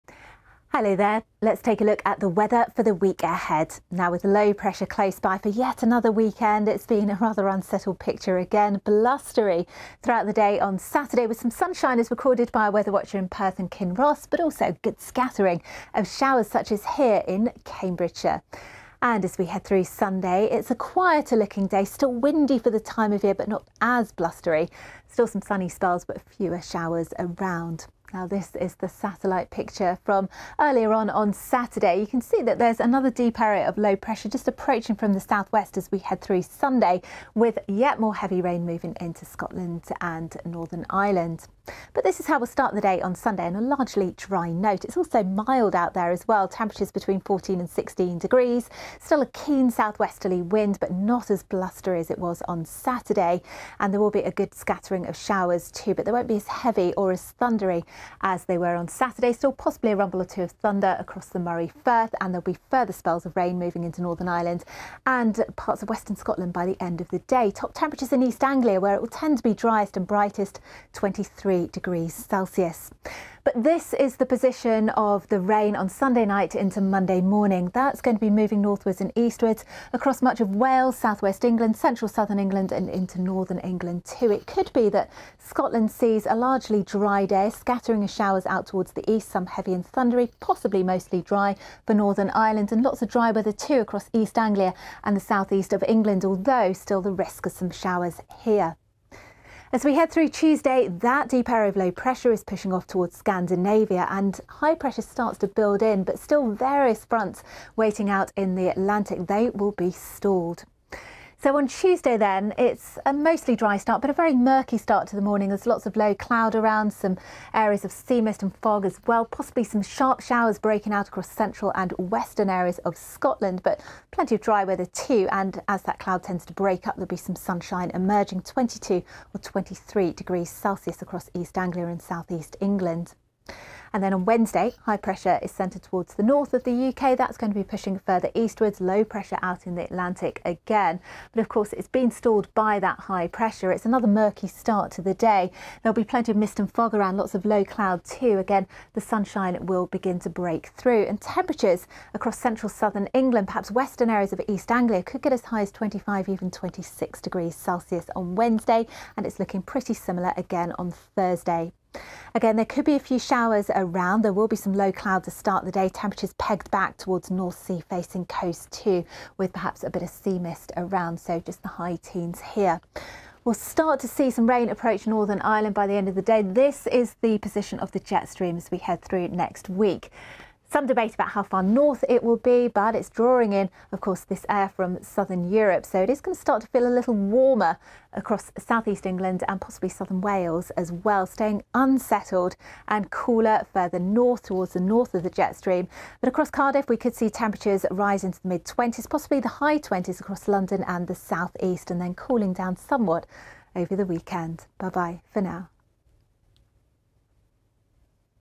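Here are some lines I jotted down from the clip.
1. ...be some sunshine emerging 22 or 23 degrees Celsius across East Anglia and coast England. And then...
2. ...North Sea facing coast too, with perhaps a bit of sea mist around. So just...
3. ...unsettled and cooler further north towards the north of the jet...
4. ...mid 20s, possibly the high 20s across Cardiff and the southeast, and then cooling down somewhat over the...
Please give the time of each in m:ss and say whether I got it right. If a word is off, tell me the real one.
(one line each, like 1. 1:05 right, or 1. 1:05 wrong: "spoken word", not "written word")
1. 2:07 wrong: "southeast", not "coast"
2. 2:47 right
3. 3:11 right
4. 3:18 wrong: "London", not "Cardiff".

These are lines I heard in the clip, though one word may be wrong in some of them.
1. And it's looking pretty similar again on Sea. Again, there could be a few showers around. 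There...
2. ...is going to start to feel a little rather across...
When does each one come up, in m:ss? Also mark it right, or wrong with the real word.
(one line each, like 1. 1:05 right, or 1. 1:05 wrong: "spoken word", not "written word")
1. 2:39 wrong: "Thursday", not "Sea"
2. 3:06 wrong: "warmer", not "rather".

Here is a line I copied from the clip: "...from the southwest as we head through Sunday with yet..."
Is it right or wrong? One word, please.
right.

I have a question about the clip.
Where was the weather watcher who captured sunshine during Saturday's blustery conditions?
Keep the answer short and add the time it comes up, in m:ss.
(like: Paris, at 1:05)
Perth and Kinross, at 0:13.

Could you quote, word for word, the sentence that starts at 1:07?
Top temperatures in East Anglia, where it will tend to be driest and brightest, 23 degrees Celsius.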